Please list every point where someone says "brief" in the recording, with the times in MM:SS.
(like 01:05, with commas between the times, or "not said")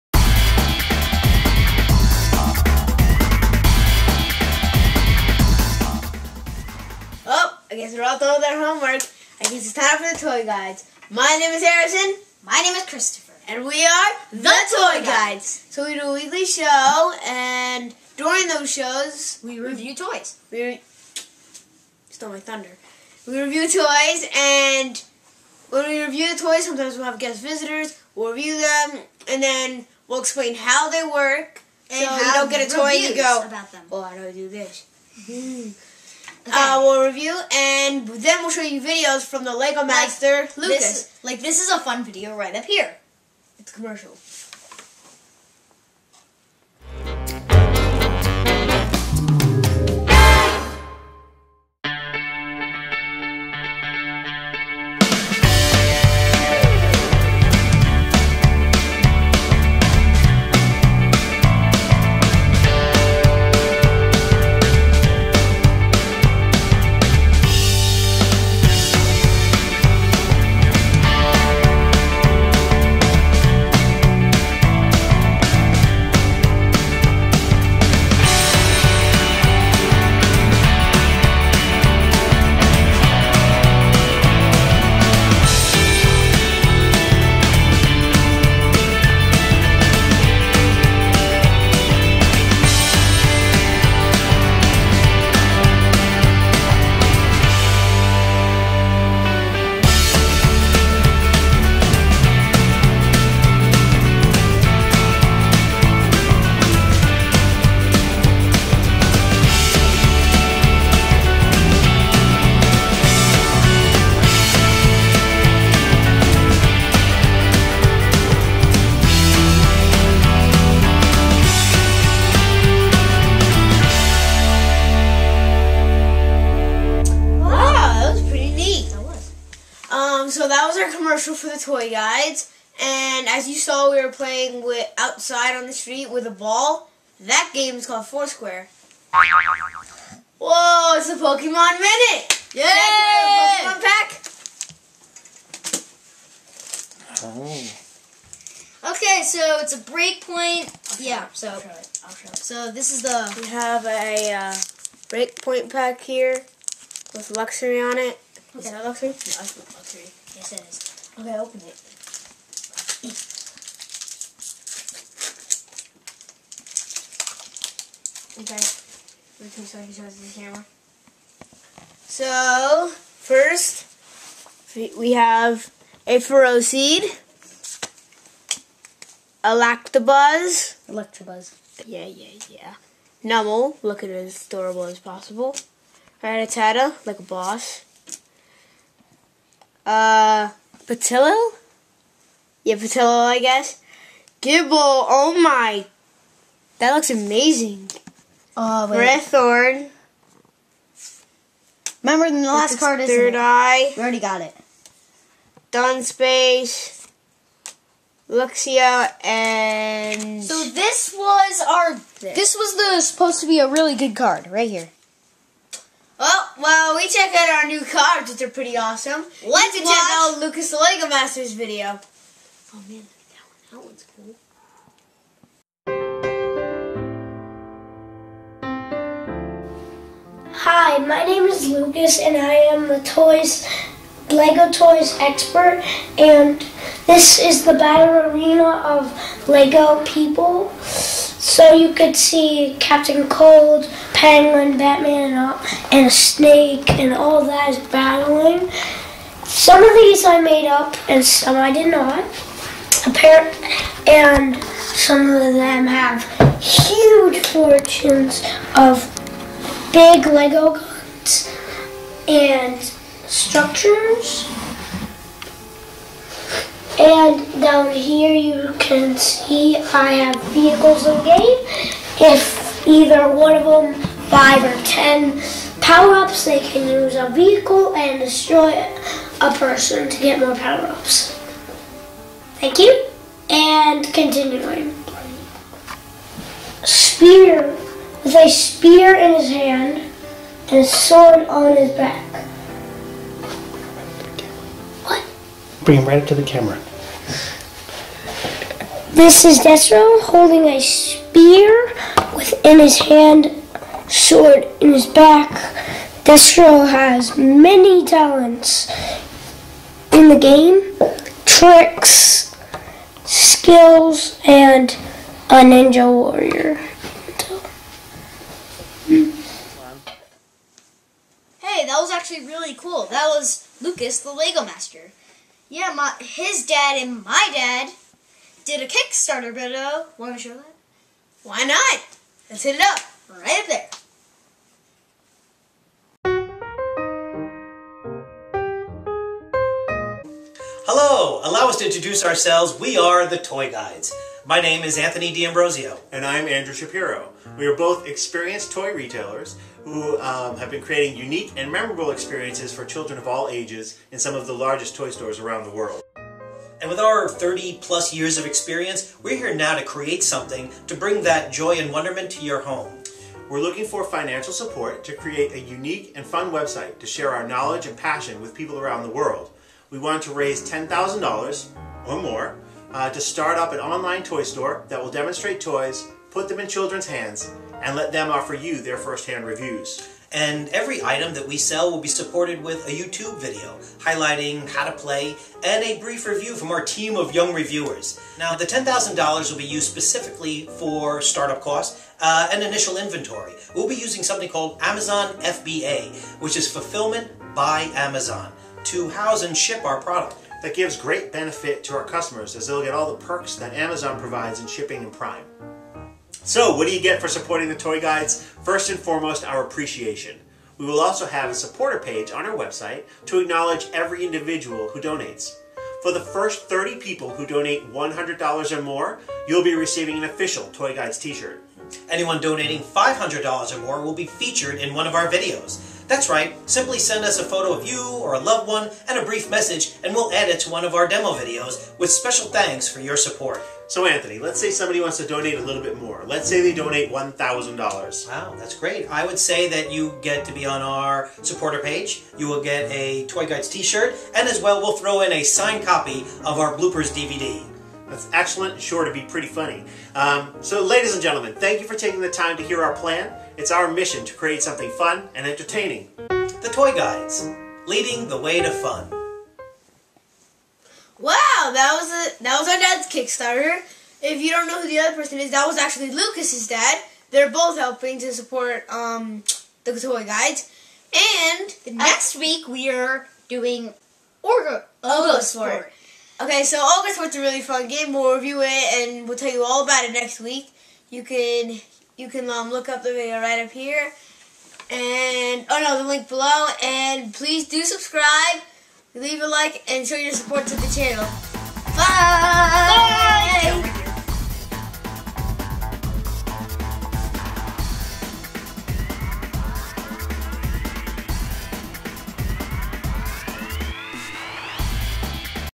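06:25, 07:09.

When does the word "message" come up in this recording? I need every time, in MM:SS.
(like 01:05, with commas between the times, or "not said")
07:09.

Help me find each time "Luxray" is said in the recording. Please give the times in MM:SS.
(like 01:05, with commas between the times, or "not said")
02:37, 03:28.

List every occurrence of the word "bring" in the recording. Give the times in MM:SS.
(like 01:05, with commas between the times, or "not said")
04:55, 06:00.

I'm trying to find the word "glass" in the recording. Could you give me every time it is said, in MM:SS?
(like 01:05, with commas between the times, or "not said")
not said.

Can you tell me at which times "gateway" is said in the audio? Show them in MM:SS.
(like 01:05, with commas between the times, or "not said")
not said.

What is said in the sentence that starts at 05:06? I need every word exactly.
Destro has many talents in the game, tricks, skills, and a ninja warrior.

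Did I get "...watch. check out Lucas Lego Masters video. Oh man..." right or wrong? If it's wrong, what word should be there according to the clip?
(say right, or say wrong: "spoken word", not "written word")
right.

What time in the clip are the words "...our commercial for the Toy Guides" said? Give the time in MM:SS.
02:10.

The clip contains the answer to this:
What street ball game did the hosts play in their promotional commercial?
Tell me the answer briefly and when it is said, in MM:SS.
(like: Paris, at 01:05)
Foursquare, at 02:18.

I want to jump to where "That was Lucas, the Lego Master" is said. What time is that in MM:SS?
05:23.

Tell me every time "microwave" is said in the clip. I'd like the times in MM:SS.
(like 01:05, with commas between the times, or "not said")
not said.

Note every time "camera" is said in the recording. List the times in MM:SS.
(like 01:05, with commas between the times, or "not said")
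02:50, 04:56.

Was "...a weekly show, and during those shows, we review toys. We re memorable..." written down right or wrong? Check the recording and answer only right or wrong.
wrong.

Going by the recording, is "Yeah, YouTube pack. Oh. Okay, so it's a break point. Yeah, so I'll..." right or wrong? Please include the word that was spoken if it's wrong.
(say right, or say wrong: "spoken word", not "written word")
wrong: "Pokemon", not "YouTube".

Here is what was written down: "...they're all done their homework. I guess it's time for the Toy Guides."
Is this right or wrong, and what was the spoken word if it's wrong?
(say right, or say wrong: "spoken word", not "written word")
right.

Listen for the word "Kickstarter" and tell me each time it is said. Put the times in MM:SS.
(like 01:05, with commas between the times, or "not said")
05:28, 07:43.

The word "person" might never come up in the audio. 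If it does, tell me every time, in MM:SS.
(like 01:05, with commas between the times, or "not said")
04:39, 07:45.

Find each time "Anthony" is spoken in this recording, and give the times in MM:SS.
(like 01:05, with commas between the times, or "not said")
05:44, 07:14.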